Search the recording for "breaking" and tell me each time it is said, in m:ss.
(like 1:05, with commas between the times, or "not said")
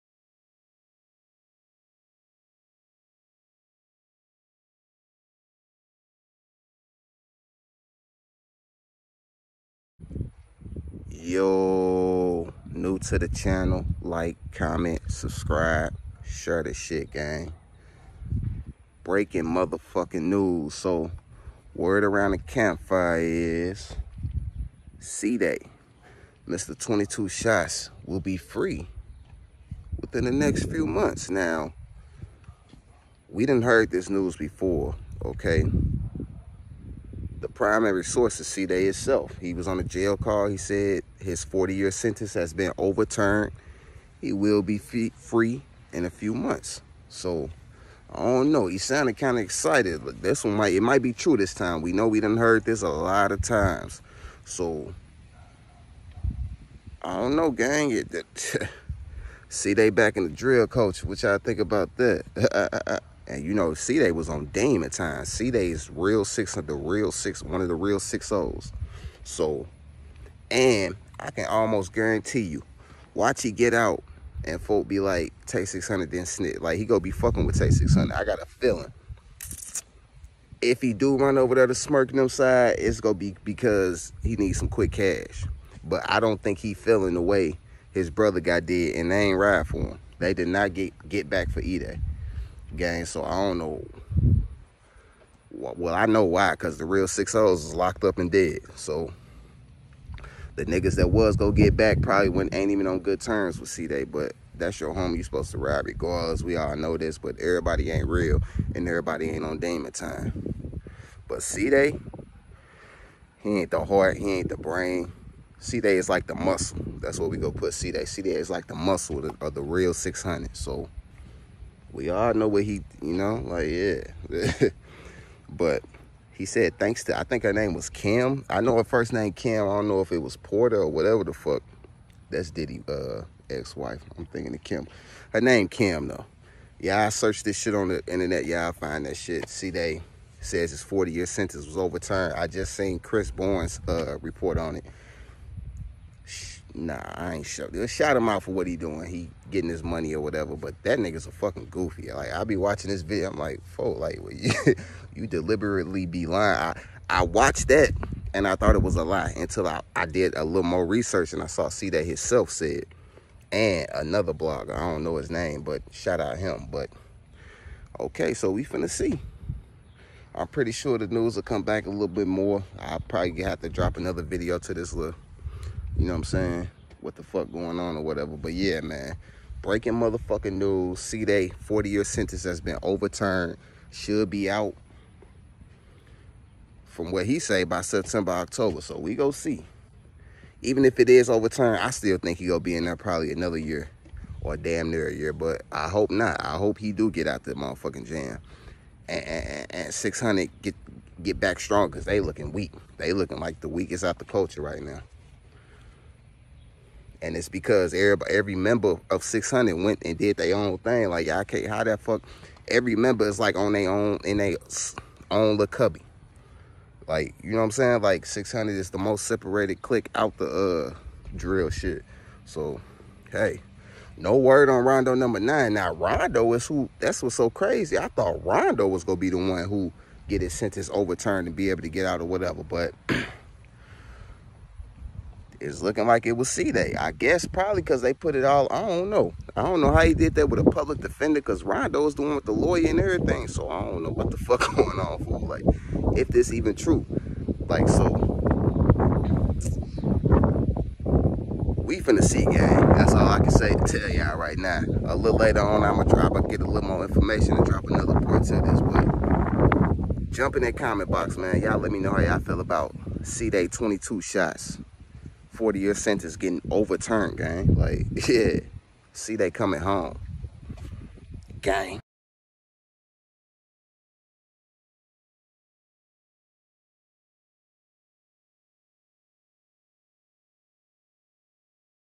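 0:19, 2:59.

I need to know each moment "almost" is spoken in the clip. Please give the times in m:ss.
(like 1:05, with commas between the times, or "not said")
1:11.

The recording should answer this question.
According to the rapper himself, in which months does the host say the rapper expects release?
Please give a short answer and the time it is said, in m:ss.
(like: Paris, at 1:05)
September, October, at 3:07.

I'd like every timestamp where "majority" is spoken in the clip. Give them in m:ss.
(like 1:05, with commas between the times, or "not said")
not said.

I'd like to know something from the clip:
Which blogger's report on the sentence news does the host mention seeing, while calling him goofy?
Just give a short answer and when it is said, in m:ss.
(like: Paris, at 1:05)
Chris Bourne, at 2:22.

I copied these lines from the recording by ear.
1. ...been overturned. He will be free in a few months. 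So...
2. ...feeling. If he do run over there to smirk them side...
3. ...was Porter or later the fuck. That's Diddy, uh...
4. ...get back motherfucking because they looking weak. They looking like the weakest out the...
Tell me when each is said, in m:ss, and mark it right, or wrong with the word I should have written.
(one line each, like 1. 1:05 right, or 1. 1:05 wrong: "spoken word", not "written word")
1. 0:42 right
2. 1:18 right
3. 2:10 wrong: "whatever", not "later"
4. 3:21 wrong: "strong", not "motherfucking".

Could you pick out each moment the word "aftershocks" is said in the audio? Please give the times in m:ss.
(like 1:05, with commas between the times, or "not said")
not said.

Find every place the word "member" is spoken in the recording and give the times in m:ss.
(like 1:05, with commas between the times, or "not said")
3:28, 3:32.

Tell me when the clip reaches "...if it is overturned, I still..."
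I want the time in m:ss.
3:10.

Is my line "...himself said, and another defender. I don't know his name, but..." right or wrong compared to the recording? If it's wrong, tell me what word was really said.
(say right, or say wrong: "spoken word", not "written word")
wrong: "blogger", not "defender".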